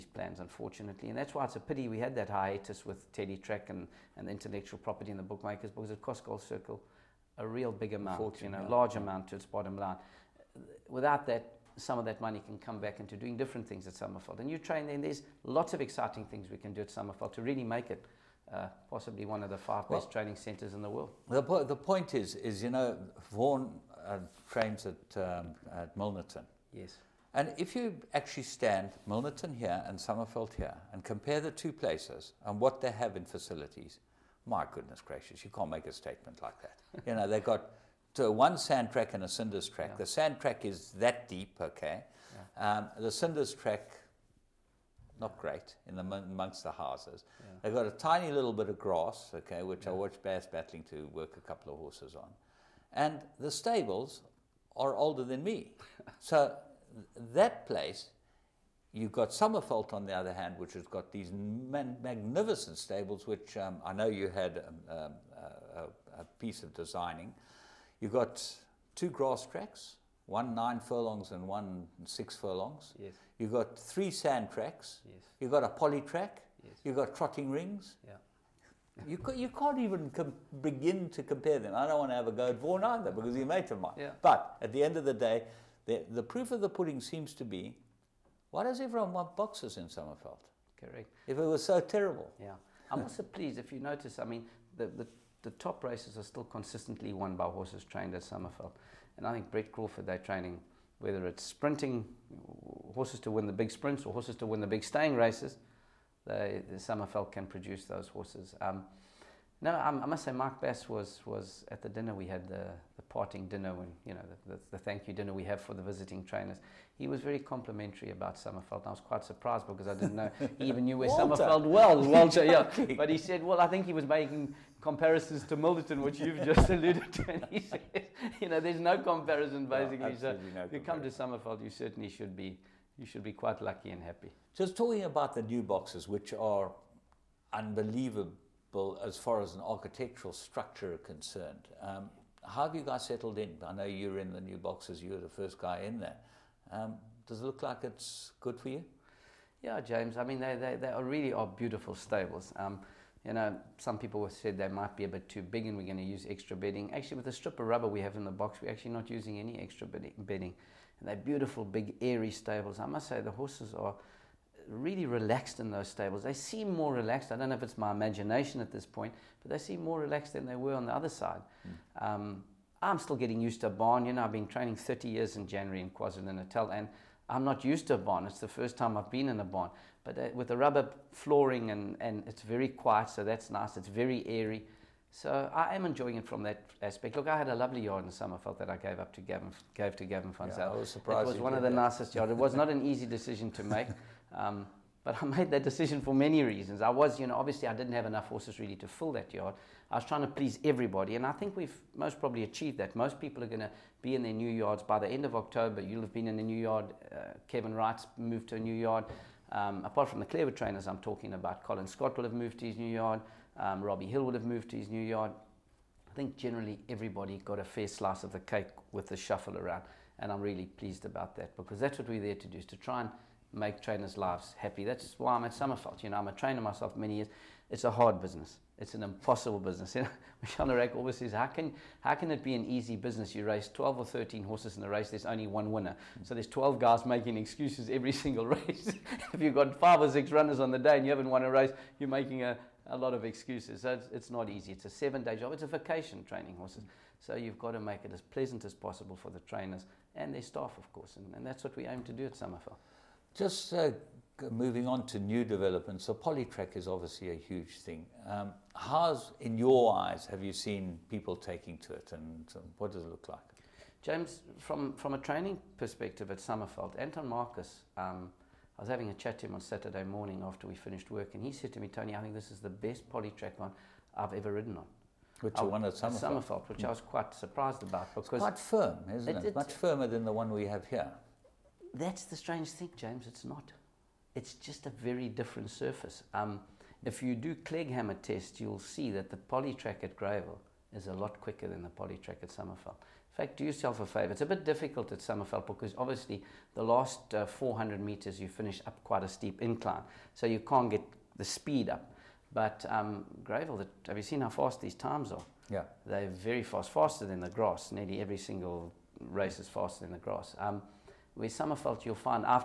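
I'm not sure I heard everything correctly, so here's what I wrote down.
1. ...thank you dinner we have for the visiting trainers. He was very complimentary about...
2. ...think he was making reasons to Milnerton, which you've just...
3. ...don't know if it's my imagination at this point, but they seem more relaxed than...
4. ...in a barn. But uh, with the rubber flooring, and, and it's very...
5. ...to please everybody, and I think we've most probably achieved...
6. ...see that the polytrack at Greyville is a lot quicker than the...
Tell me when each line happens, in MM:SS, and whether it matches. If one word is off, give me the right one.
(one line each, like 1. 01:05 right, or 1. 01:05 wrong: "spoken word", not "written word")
1. 01:54 right
2. 02:03 wrong: "comparisons", not "reasons"
3. 02:47 right
4. 02:59 right
5. 03:20 right
6. 04:48 right.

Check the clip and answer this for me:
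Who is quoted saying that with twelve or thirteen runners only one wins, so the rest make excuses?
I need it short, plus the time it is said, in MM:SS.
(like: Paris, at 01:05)
Michel Nairac, at 03:50.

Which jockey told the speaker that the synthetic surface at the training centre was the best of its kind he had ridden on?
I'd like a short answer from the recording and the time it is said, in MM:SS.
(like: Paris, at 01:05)
Anton Marcus, at 04:26.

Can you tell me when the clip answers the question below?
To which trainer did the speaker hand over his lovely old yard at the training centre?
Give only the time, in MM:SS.
03:10.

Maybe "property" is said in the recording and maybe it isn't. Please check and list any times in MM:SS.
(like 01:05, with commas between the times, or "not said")
00:04.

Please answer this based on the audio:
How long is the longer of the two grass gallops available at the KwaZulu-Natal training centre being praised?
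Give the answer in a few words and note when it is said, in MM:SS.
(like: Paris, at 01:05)
9 furlongs, at 01:10.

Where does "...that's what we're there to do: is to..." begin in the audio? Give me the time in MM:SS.
03:41.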